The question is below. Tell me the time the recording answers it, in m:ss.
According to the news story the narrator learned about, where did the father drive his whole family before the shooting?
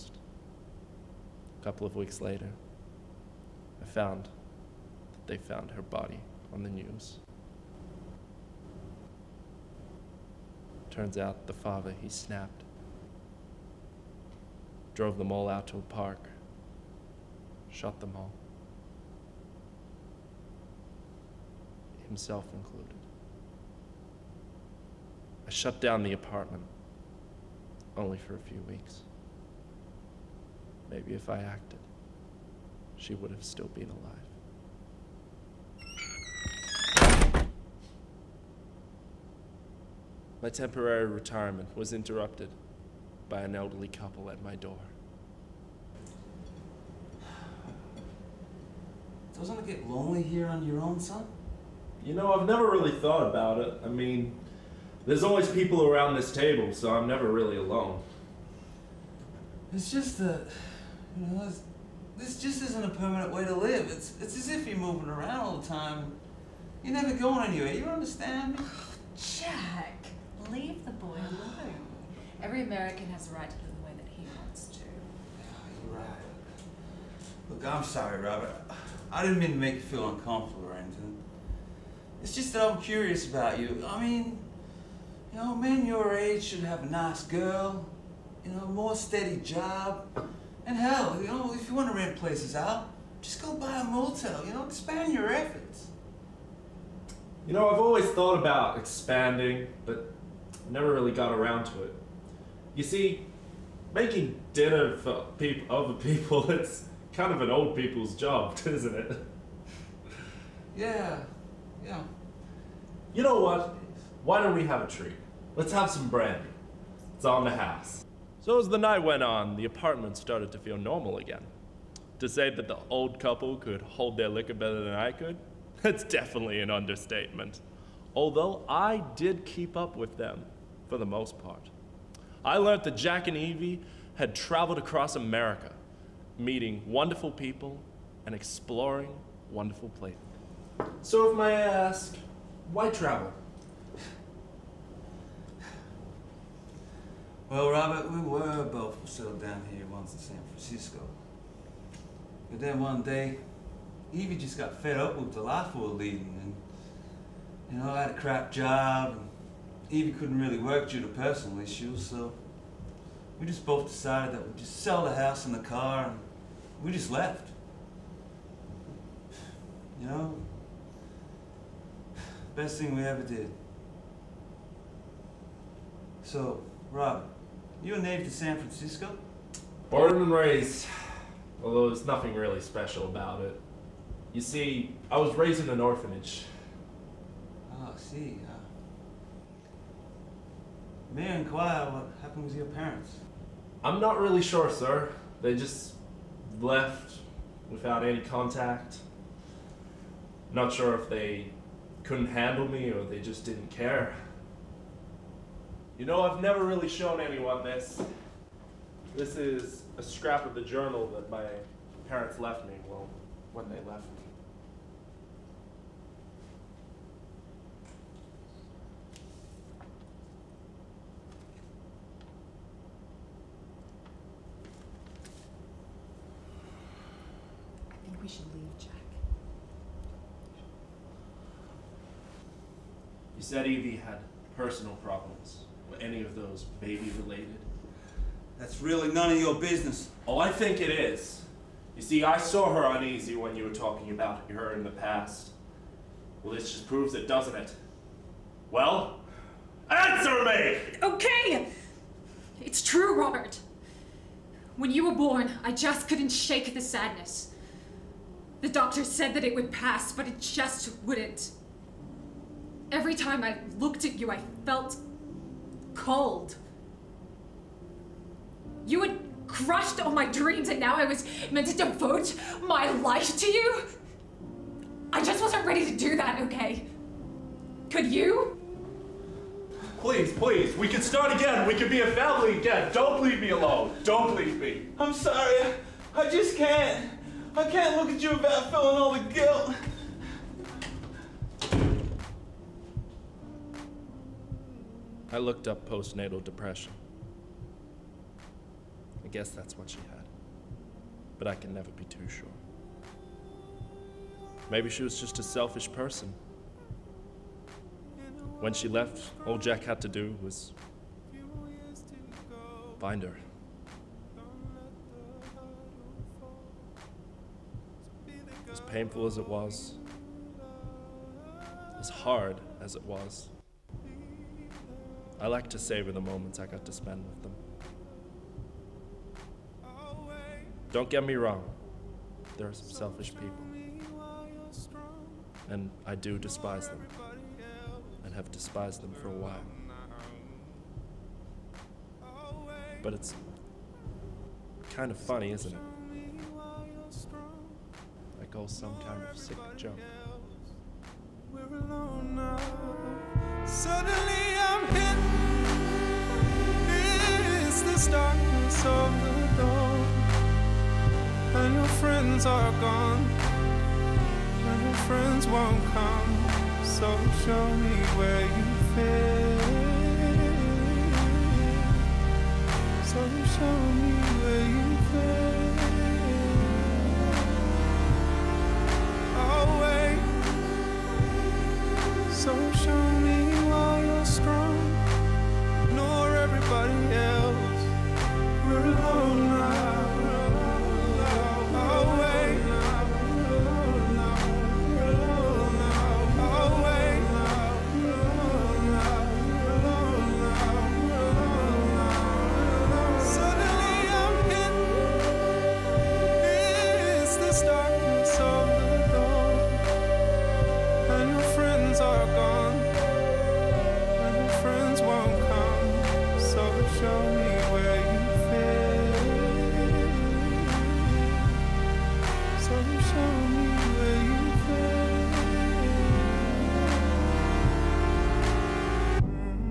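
0:15.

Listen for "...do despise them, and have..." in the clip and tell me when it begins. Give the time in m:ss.
5:36.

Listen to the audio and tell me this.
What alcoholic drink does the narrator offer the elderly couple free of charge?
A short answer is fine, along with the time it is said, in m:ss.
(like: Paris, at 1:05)
Brandy, at 1:56.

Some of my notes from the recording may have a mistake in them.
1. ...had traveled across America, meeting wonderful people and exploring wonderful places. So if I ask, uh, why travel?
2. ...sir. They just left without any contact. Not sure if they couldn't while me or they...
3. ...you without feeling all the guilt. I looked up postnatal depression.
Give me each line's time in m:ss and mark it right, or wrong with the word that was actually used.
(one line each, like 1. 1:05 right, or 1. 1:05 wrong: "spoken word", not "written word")
1. 2:14 right
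2. 3:14 wrong: "handle", not "while"
3. 4:48 right.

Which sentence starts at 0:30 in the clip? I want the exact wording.
Maybe if I acted, she would have still been alive.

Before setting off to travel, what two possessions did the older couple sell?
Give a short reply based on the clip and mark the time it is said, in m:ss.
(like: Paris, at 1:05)
The house and the car, at 2:45.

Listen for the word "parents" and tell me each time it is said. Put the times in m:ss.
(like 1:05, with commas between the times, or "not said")
3:12, 3:32.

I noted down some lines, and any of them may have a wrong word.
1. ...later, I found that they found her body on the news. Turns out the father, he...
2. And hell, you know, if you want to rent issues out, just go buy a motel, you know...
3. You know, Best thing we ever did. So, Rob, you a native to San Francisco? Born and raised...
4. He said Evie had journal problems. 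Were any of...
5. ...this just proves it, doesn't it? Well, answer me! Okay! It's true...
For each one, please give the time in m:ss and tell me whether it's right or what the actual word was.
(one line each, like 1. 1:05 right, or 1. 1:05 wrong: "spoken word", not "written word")
1. 0:02 right
2. 1:30 wrong: "places", not "issues"
3. 2:49 right
4. 3:53 wrong: "personal", not "journal"
5. 4:06 right.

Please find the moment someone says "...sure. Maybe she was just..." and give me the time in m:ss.
5:02.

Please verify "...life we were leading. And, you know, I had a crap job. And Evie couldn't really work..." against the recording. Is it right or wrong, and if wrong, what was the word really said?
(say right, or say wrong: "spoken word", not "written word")
right.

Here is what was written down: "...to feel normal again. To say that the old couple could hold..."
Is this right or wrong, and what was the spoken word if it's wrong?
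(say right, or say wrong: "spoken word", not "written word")
right.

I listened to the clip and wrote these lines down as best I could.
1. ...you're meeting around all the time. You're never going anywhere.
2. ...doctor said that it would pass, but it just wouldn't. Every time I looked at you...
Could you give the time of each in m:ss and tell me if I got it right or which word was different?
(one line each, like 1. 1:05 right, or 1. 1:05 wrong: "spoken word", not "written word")
1. 1:04 wrong: "moving", not "meeting"
2. 4:18 right.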